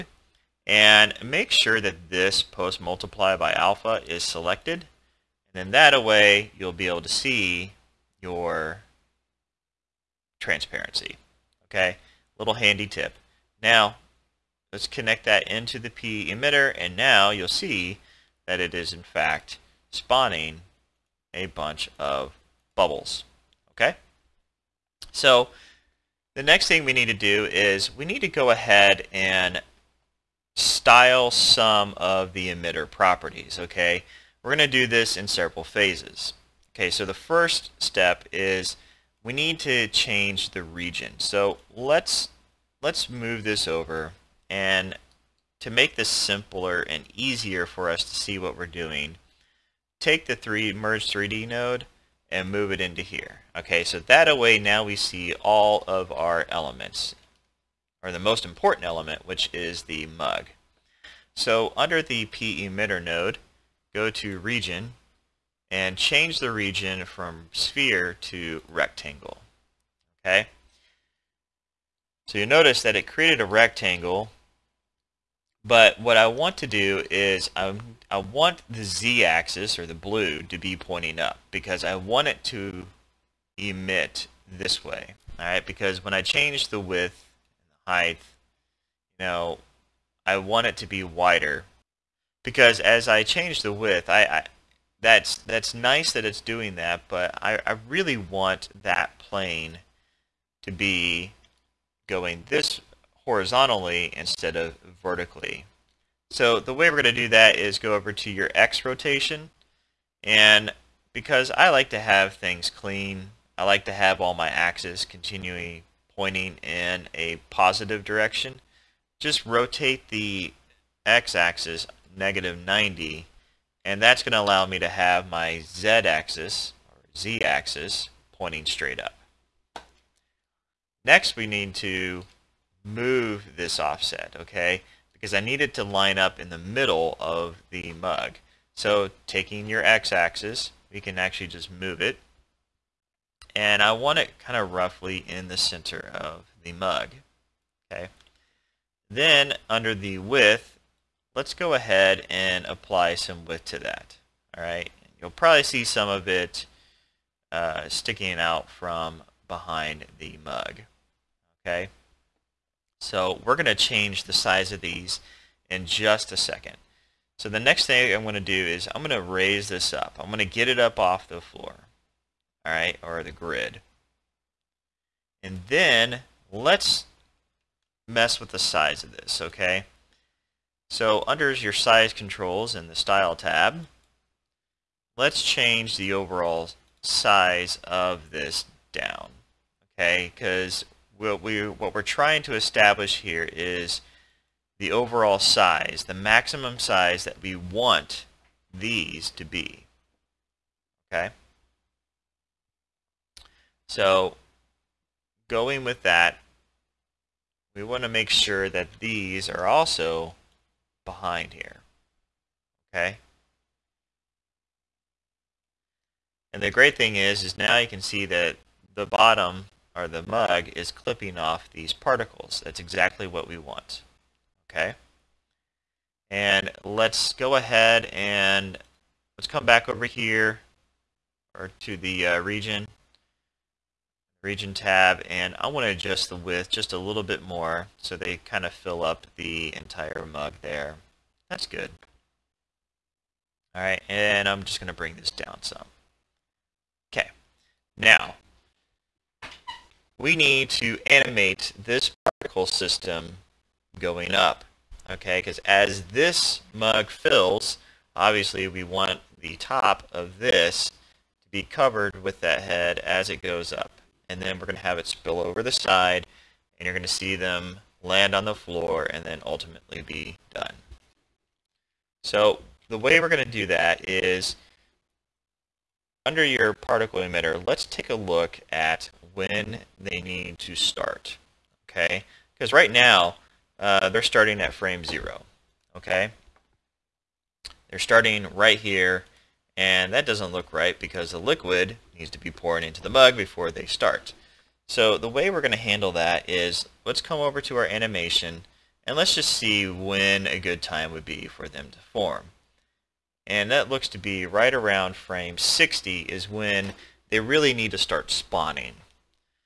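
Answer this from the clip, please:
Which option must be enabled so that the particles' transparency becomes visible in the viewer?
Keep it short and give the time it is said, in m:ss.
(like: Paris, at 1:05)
Post multiply by alpha, at 0:02.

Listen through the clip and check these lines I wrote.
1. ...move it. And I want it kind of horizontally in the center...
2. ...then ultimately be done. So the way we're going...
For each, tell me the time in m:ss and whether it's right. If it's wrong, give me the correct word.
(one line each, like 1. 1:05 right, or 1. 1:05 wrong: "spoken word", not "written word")
1. 2:21 wrong: "roughly", not "horizontally"
2. 4:29 right.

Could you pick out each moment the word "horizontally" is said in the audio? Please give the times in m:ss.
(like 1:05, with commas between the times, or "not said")
1:43.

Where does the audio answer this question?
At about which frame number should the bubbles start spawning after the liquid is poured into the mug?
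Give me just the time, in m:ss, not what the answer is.
5:05.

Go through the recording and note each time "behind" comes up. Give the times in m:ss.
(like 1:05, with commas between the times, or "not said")
2:39, 3:31.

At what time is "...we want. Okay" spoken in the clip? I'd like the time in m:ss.
3:43.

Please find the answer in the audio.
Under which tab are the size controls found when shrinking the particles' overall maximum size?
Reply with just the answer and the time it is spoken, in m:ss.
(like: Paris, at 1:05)
Style tab, at 3:02.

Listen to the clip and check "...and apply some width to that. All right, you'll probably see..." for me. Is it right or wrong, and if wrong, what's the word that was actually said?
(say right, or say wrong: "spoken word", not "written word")
right.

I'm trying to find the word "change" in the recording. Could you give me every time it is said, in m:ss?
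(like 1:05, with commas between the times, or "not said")
0:39, 1:05, 1:26, 1:33, 2:43, 3:05.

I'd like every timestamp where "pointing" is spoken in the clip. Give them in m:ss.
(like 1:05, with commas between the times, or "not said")
1:20, 1:56, 2:08.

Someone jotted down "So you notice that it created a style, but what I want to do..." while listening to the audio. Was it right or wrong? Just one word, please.
wrong.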